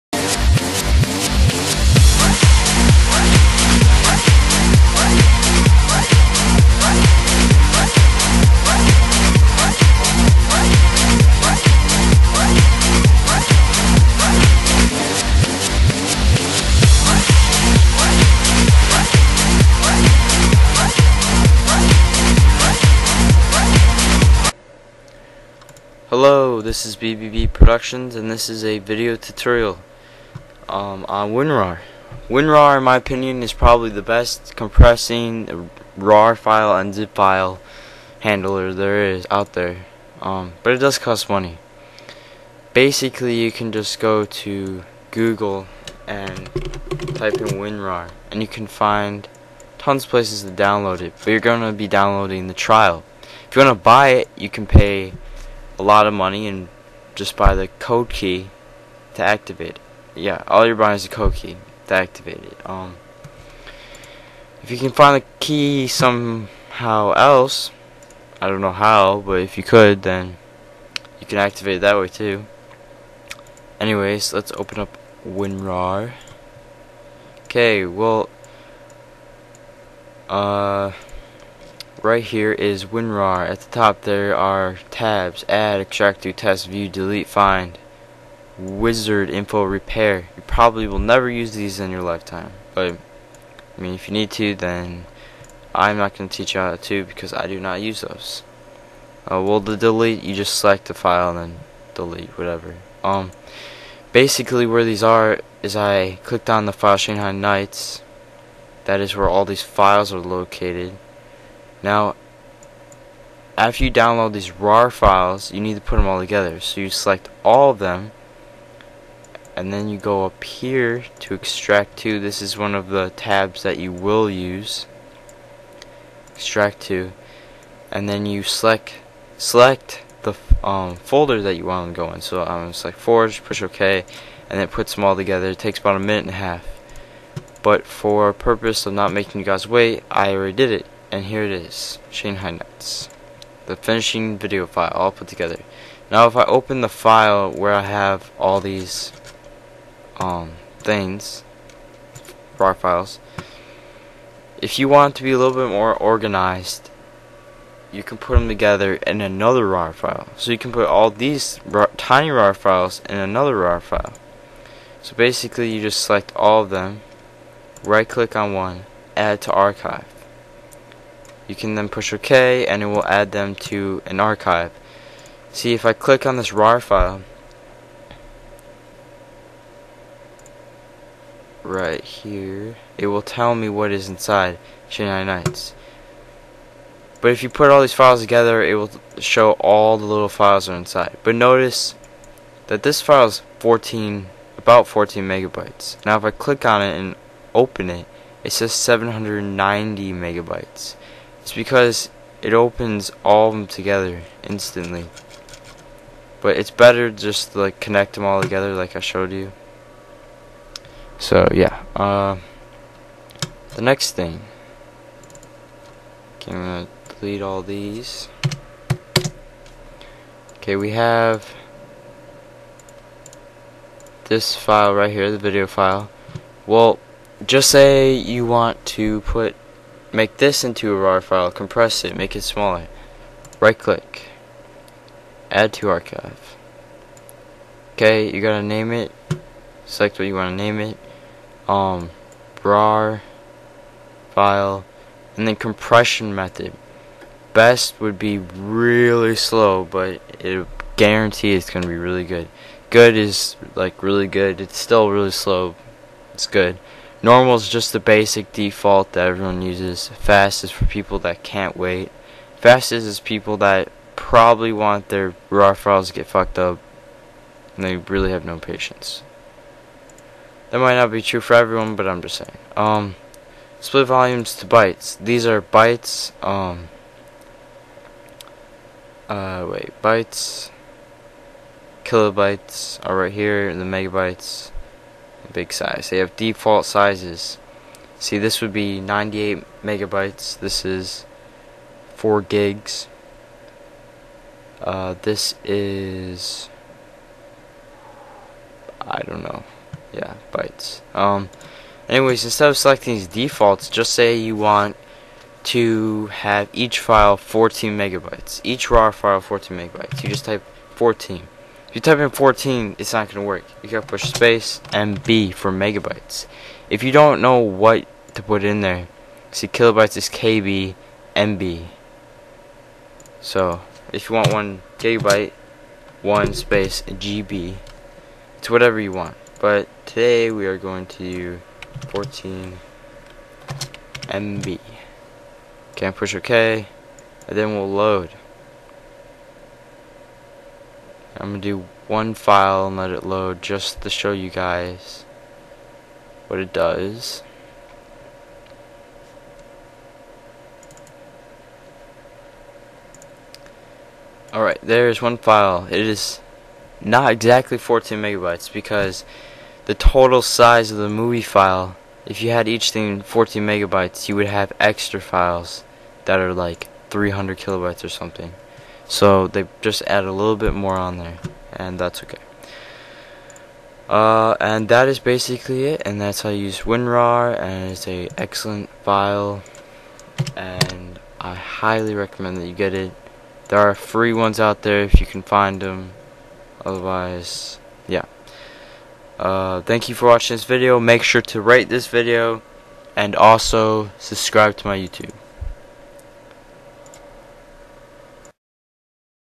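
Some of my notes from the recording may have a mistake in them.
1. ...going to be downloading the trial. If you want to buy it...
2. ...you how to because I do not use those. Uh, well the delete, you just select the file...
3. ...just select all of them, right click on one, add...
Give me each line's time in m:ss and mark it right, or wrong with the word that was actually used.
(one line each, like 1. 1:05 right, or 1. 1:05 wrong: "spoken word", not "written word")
1. 0:51 right
2. 1:36 right
3. 2:45 right.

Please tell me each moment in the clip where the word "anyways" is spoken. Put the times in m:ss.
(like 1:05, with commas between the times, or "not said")
1:13, 5:02.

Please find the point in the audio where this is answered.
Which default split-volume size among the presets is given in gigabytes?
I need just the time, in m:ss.
4:52.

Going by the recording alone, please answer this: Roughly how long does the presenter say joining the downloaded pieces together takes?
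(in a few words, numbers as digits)
a minute and a half.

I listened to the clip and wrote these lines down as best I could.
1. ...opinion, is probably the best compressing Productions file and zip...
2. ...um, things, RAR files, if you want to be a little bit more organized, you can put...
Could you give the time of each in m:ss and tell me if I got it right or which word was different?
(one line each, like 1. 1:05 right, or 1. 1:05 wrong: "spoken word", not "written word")
1. 0:32 wrong: "RAR", not "Productions"
2. 2:30 right.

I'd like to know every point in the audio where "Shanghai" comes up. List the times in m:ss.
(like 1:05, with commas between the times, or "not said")
1:46, 2:22, 3:04.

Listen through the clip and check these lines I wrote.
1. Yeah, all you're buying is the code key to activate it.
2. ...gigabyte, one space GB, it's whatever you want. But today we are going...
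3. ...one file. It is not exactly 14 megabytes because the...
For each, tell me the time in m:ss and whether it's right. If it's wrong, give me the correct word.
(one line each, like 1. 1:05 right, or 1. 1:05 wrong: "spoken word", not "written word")
1. 1:00 right
2. 5:24 right
3. 5:55 right.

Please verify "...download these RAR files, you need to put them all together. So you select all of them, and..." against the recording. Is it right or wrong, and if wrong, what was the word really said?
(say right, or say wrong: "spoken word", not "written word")
right.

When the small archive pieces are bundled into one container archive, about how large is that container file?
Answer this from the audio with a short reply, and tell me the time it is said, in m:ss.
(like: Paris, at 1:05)
14 megabytes, at 3:14.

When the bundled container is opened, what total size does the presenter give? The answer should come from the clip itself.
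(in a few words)
790 megabytes.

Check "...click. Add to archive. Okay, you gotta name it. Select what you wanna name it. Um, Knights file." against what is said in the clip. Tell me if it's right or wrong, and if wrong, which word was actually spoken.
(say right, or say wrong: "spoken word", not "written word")
wrong: "RAR", not "Knights".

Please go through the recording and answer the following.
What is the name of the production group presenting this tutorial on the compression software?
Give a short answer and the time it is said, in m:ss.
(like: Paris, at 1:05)
BBB Productions, at 0:26.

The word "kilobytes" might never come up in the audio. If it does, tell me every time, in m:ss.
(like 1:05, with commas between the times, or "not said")
4:42, 5:19, 6:07.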